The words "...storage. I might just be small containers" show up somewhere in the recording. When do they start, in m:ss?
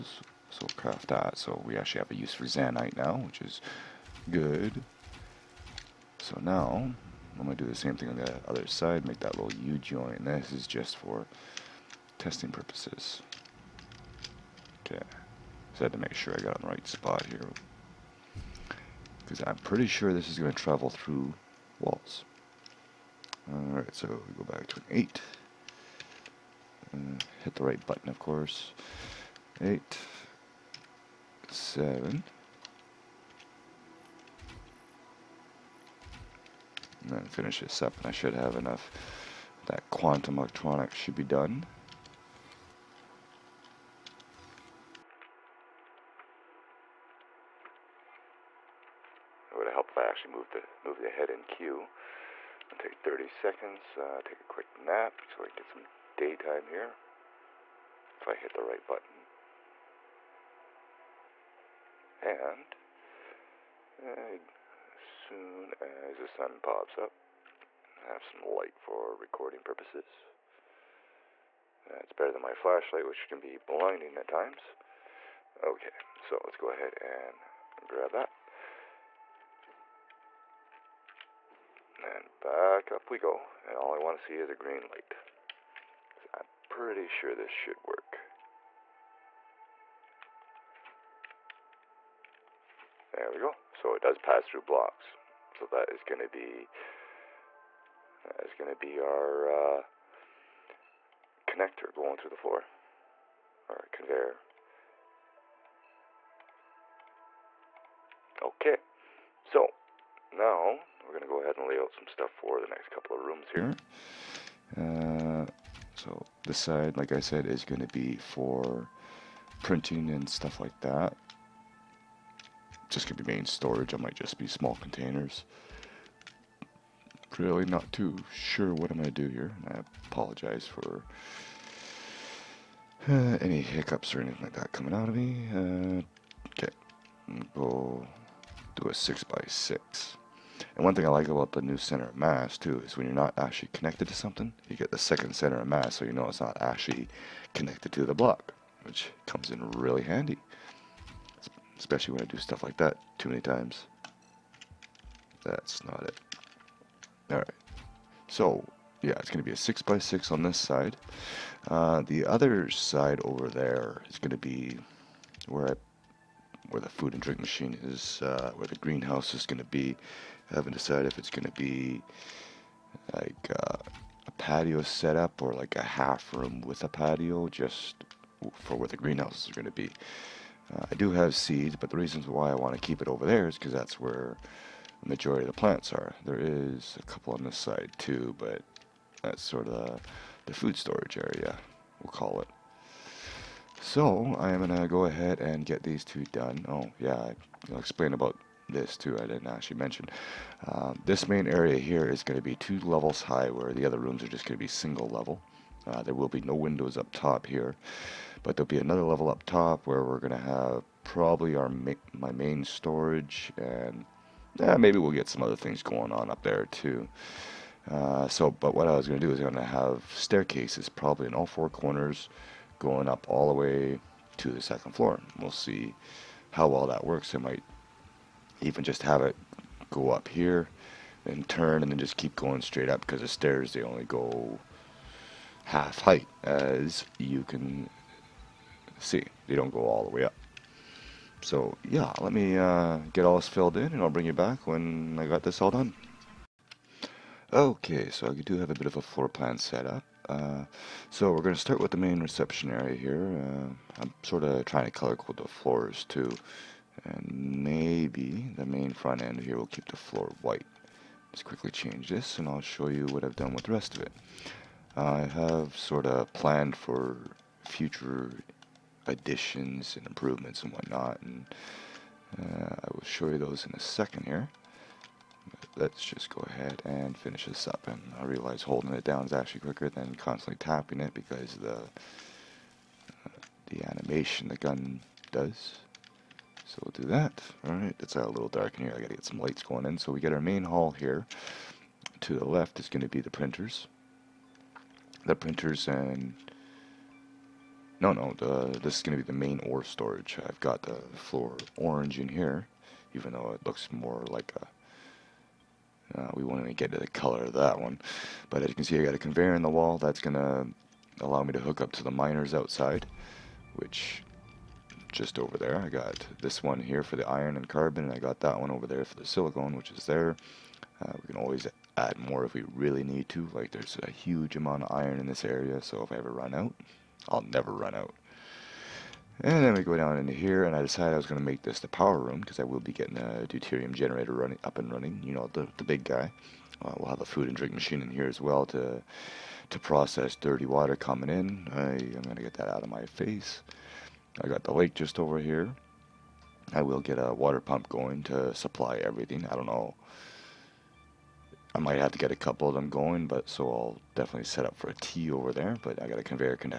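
2:03.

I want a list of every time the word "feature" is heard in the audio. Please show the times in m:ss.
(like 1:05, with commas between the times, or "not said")
not said.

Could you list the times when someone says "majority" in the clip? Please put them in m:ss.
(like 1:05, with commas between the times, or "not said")
3:05.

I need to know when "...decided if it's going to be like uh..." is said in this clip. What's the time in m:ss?
2:50.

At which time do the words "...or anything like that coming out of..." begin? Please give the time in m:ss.
2:14.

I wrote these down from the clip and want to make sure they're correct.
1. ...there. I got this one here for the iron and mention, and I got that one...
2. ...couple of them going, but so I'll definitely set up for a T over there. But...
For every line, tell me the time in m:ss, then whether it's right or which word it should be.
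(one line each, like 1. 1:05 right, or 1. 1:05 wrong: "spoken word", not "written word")
1. 5:15 wrong: "carbon", not "mention"
2. 5:52 right.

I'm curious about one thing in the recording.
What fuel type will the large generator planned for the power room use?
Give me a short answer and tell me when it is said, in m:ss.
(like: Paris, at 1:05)
deuterium, at 5:33.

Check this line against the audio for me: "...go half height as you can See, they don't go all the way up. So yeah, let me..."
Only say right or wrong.
right.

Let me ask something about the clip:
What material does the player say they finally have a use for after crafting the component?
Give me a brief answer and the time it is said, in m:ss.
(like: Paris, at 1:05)
Xaenite, at 0:02.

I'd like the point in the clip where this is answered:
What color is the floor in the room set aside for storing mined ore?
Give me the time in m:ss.
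5:01.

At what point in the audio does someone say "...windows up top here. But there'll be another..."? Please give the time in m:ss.
3:26.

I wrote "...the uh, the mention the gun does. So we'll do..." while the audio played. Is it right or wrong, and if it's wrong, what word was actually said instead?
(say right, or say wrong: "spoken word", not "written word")
wrong: "animation", not "mention".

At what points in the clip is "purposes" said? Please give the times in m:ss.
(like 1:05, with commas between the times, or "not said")
0:12, 1:09.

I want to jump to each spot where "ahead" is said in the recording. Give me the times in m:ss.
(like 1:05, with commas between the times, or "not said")
1:16, 1:51, 3:15, 4:36.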